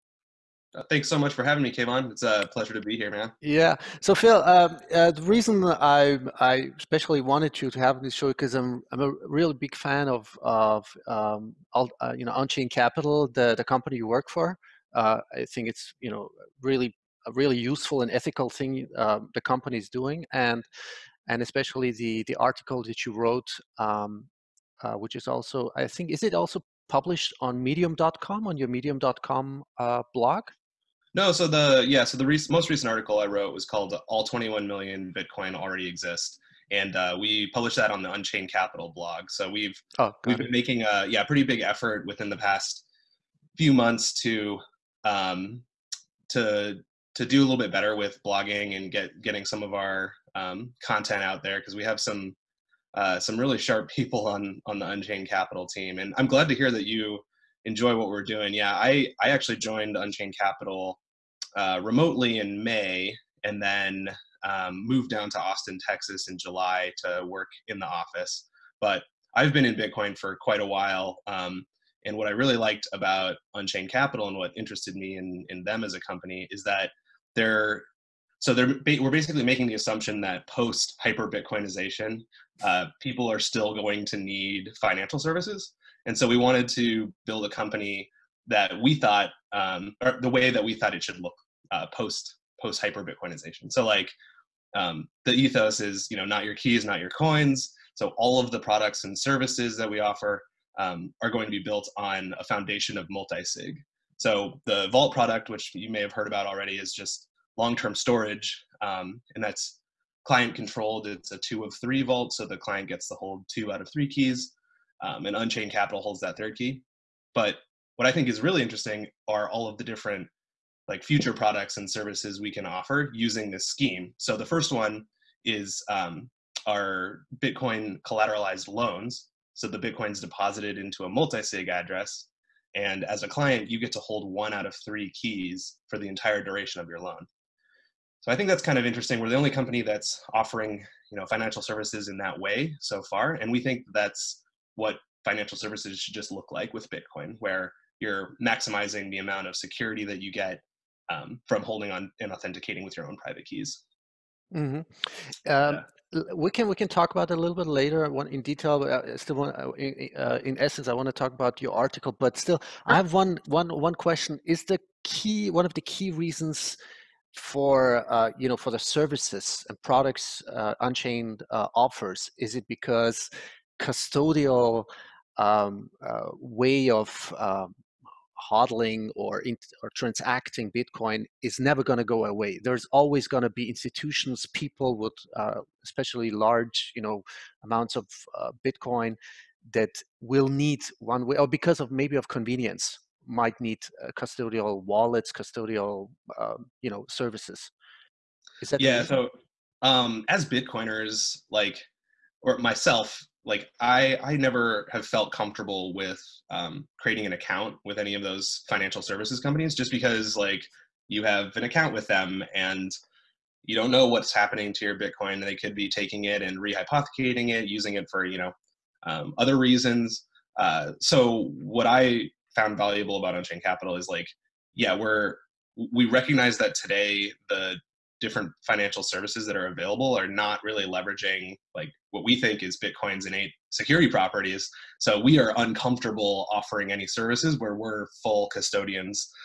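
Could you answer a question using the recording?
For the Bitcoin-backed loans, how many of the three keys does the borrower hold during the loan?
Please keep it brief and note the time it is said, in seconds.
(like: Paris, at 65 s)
1, at 134 s.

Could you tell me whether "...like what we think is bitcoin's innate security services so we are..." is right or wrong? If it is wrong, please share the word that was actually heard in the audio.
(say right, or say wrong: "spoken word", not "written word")
wrong: "properties", not "services".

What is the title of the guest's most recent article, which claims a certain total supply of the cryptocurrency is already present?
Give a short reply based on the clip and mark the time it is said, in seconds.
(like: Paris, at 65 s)
All 21 Million Bitcoin Already Exist, at 34 s.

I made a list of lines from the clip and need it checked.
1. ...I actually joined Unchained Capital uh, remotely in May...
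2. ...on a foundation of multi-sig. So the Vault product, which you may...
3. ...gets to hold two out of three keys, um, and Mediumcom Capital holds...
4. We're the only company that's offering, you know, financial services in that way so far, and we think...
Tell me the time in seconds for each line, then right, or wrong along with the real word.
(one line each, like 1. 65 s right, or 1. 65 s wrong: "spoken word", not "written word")
1. 59 s right
2. 101 s right
3. 112 s wrong: "Unchained", not "Mediumcom"
4. 139 s right.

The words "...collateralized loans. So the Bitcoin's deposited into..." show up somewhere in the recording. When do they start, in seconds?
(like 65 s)
128 s.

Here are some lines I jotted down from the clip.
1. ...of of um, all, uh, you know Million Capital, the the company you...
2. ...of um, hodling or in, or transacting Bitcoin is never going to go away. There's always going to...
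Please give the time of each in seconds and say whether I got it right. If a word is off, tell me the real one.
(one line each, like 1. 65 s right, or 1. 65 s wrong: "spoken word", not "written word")
1. 10 s wrong: "Unchained", not "Million"
2. 176 s right.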